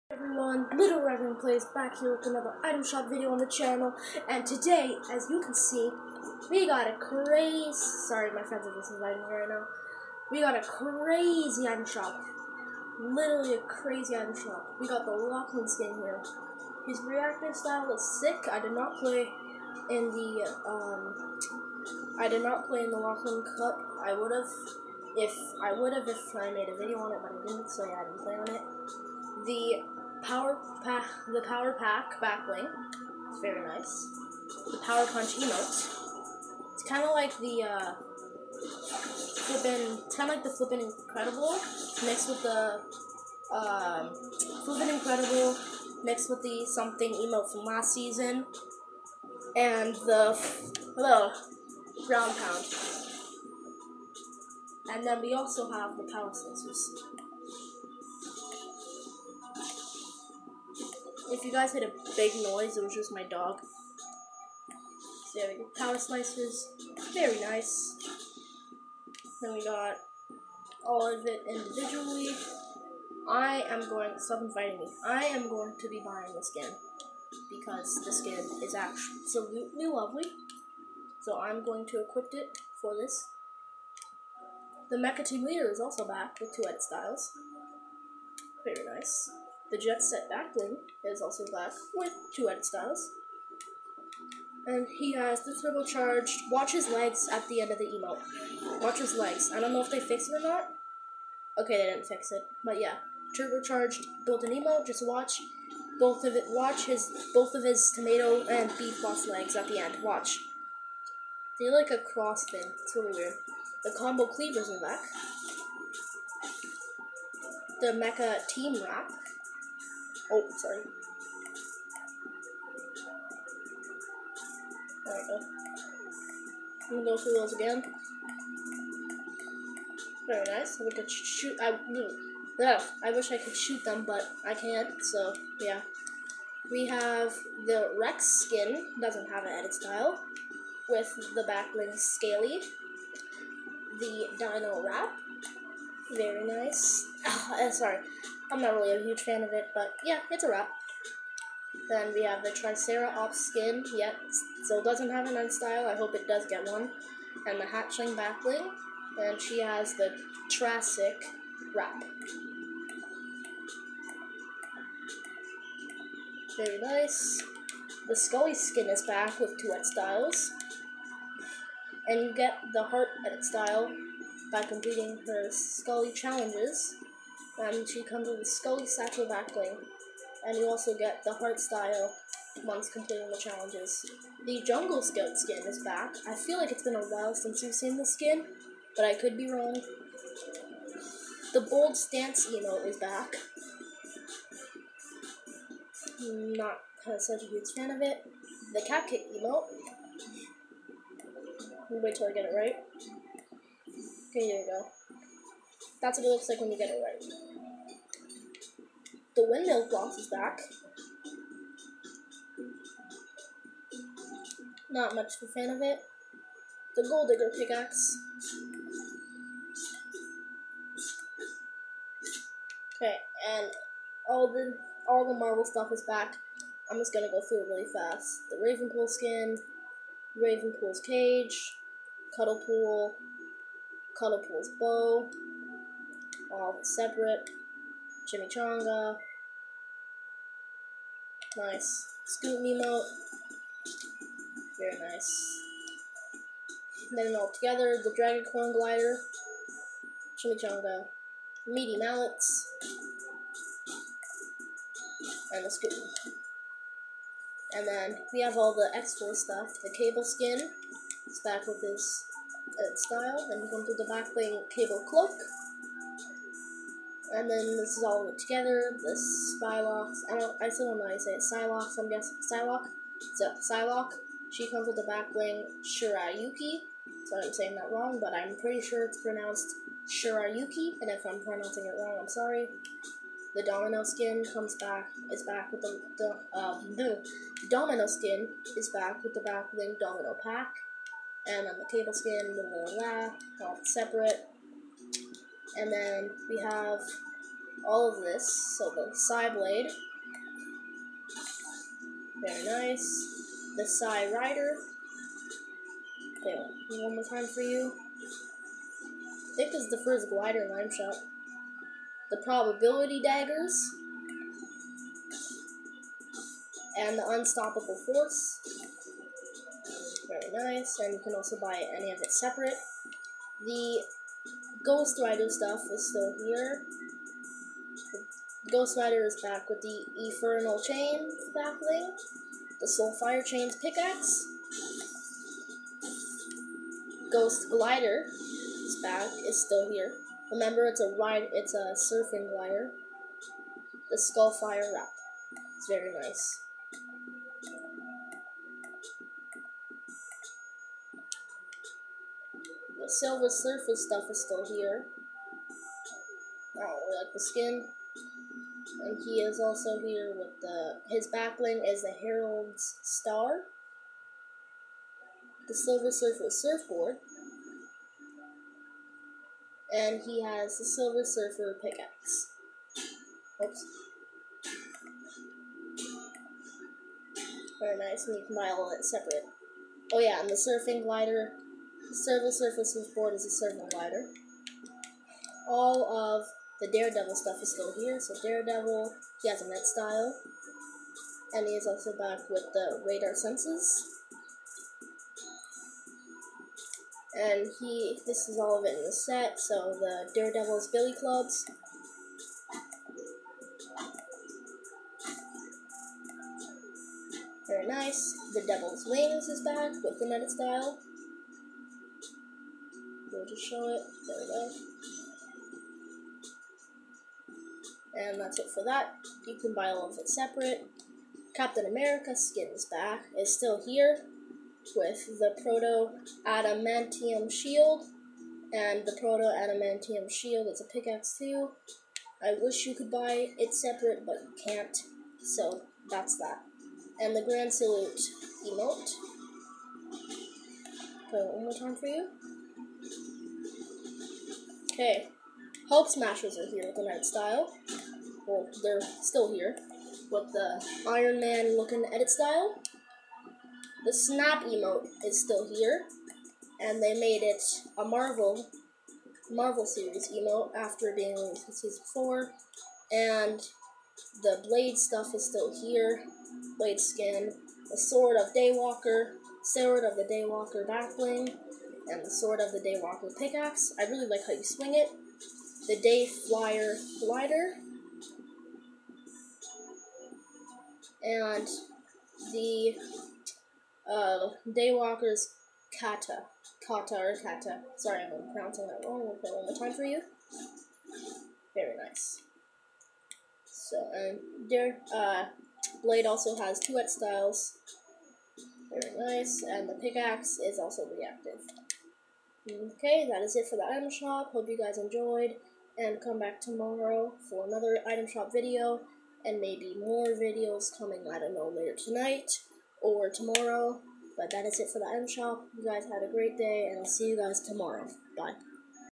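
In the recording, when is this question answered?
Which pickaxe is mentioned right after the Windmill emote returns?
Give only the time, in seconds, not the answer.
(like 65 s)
217 s.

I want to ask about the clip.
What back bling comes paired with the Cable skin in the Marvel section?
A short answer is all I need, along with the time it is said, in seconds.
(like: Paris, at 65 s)
Cable Cloak, at 264 s.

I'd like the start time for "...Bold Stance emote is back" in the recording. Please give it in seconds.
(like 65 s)
191 s.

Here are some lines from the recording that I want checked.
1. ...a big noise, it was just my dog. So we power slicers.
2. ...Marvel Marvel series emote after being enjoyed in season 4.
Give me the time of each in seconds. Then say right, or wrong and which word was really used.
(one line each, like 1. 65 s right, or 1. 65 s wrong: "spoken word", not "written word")
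1. 61 s right
2. 458 s wrong: "released", not "enjoyed".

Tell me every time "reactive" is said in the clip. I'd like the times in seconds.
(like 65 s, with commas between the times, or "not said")
17 s, 501 s.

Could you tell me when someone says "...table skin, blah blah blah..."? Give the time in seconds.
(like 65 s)
291 s.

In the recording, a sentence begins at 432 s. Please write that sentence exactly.
I wish you could buy it separate, but you can't.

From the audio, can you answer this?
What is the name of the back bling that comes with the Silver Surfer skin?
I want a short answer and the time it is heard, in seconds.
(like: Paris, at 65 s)
Herald's Star, at 362 s.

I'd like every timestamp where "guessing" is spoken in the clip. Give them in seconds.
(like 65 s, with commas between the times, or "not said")
272 s.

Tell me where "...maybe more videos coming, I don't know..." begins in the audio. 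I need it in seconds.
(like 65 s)
509 s.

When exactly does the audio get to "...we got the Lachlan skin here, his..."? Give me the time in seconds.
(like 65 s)
14 s.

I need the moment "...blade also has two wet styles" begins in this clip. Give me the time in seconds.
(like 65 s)
496 s.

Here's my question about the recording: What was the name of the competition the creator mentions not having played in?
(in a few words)
Lachlan Cup.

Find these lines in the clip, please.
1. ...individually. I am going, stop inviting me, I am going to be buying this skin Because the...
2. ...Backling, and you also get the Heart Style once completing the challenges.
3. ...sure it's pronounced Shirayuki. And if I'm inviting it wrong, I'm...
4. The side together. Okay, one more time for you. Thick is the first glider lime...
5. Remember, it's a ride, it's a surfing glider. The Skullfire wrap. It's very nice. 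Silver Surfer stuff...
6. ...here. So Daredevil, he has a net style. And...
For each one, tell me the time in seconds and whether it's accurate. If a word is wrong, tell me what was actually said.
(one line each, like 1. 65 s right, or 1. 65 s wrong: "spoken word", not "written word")
1. 71 s right
2. 179 s right
3. 278 s wrong: "pronouncing", not "inviting"
4. 303 s wrong: "rider", not "together"
5. 340 s right
6. 387 s right.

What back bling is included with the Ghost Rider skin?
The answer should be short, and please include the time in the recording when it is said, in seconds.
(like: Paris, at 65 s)
Infernal Chain, at 330 s.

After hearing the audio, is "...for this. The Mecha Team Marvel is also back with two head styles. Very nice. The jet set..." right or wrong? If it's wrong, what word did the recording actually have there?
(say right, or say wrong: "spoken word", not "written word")
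wrong: "Leader", not "Marvel".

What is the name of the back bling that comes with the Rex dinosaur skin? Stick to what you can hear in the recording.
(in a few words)
Back Scaly.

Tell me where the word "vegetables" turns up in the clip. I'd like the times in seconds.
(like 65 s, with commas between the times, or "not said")
not said.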